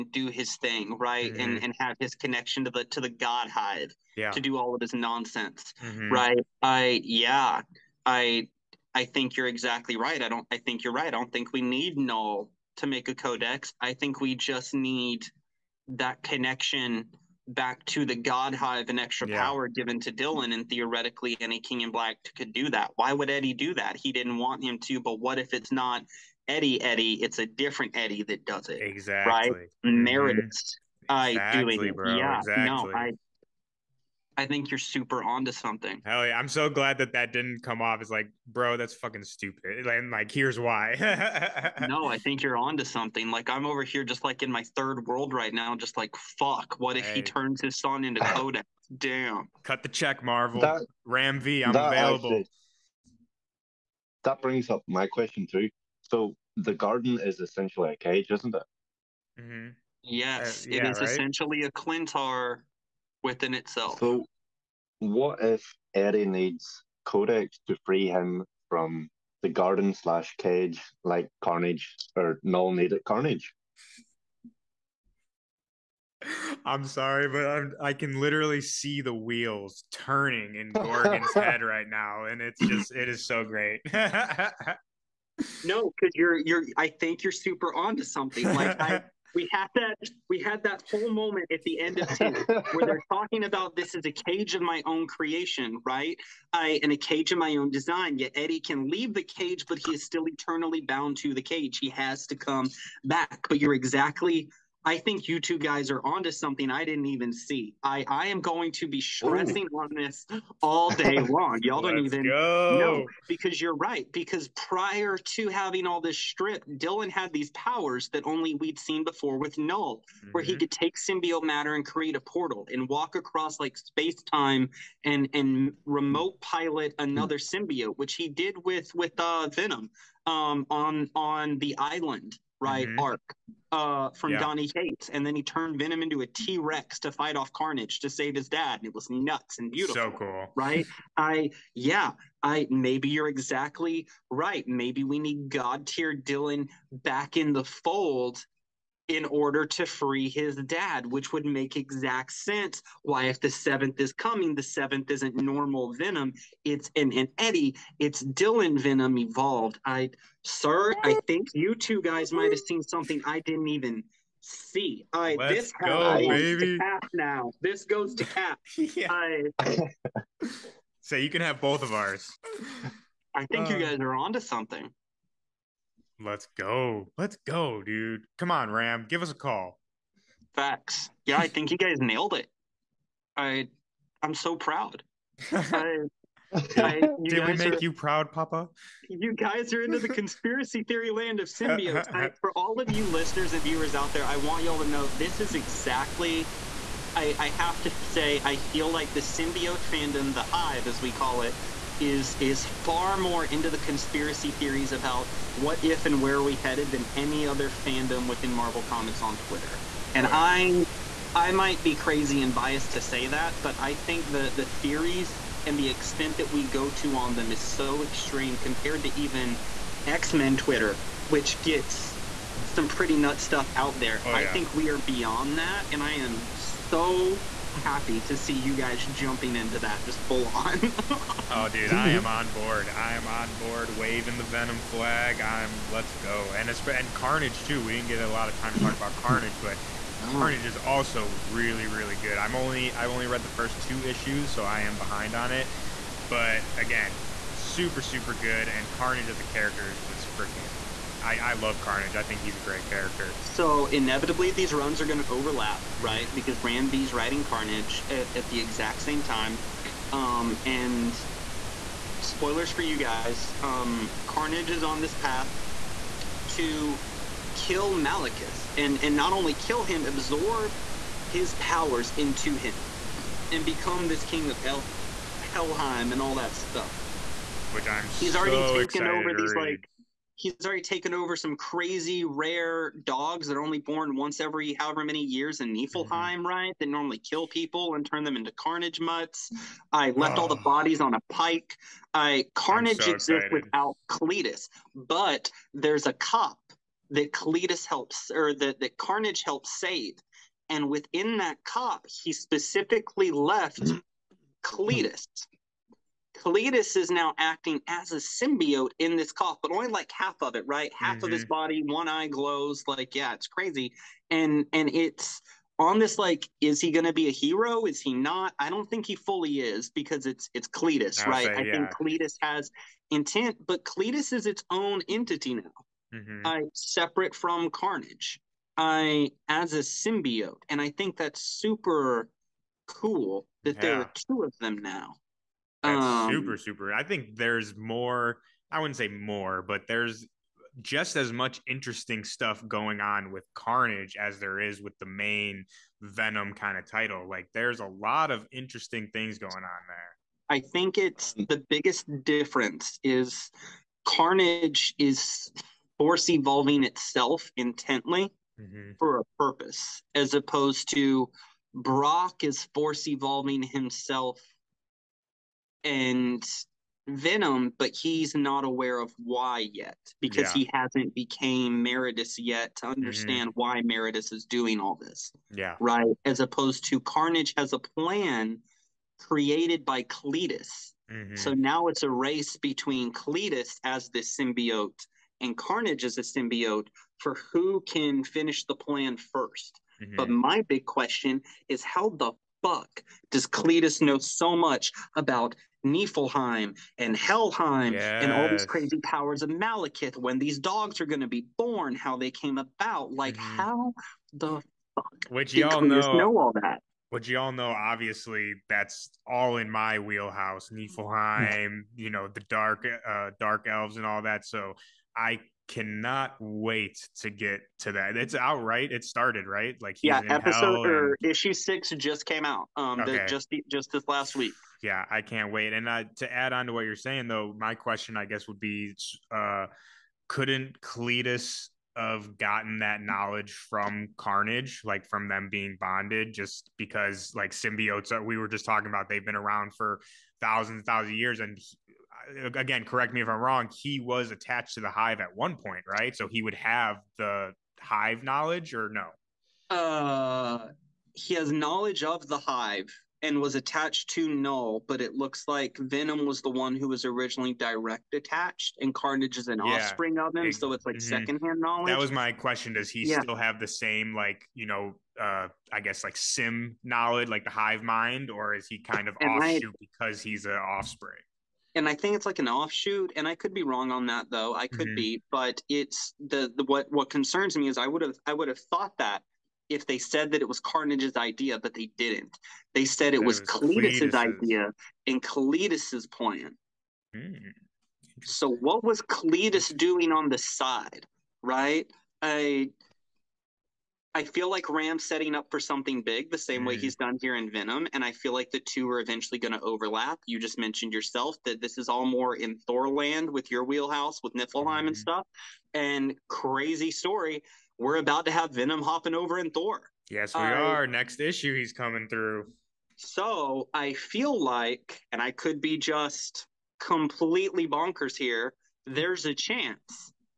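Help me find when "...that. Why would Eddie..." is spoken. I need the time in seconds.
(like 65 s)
22 s.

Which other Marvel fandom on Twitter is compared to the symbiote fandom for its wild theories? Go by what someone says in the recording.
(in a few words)
X-Men Twitter.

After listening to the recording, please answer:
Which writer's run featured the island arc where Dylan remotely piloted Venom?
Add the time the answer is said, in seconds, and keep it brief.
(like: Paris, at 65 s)
Donny Cates, at 134 s.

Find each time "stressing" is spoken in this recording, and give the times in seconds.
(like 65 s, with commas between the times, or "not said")
108 s.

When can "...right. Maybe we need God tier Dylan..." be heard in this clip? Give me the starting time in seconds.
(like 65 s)
144 s.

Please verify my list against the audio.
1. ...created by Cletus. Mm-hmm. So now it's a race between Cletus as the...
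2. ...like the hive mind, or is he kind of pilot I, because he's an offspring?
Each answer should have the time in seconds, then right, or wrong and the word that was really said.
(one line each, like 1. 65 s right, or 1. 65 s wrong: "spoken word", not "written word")
1. 379 s right
2. 467 s wrong: "offshoot", not "pilot".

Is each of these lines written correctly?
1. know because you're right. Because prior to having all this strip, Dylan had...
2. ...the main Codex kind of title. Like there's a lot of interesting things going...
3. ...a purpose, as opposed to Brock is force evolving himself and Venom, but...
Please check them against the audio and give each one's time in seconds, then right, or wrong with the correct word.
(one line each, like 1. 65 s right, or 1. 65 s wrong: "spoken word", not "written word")
1. 112 s right
2. 344 s wrong: "Venom", not "Codex"
3. 359 s right.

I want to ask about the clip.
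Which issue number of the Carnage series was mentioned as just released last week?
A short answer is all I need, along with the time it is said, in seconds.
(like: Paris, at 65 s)
6, at 421 s.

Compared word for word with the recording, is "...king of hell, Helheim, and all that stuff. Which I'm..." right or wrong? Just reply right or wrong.
right.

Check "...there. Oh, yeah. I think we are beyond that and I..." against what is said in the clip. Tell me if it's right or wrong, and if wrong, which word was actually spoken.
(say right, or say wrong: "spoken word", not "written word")
right.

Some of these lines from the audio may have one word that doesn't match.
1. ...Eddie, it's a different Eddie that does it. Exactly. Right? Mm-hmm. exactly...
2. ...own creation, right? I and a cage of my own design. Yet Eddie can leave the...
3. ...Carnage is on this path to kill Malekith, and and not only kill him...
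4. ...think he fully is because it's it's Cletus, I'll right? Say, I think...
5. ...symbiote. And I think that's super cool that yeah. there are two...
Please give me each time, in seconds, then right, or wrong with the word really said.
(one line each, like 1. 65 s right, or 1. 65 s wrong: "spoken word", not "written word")
1. 26 s right
2. 94 s right
3. 264 s right
4. 318 s right
5. 329 s right.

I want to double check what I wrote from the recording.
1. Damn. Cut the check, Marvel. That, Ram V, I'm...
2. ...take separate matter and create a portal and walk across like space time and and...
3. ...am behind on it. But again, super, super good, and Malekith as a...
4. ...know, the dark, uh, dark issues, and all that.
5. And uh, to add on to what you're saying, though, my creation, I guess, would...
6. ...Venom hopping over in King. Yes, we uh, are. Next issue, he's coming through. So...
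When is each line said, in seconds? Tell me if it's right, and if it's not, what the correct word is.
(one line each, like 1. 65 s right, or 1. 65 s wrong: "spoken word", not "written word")
1. 48 s right
2. 120 s wrong: "symbiote", not "separate"
3. 244 s wrong: "Carnage", not "Malekith"
4. 412 s wrong: "elves", not "issues"
5. 425 s wrong: "question", not "creation"
6. 508 s wrong: "Thor", not "King".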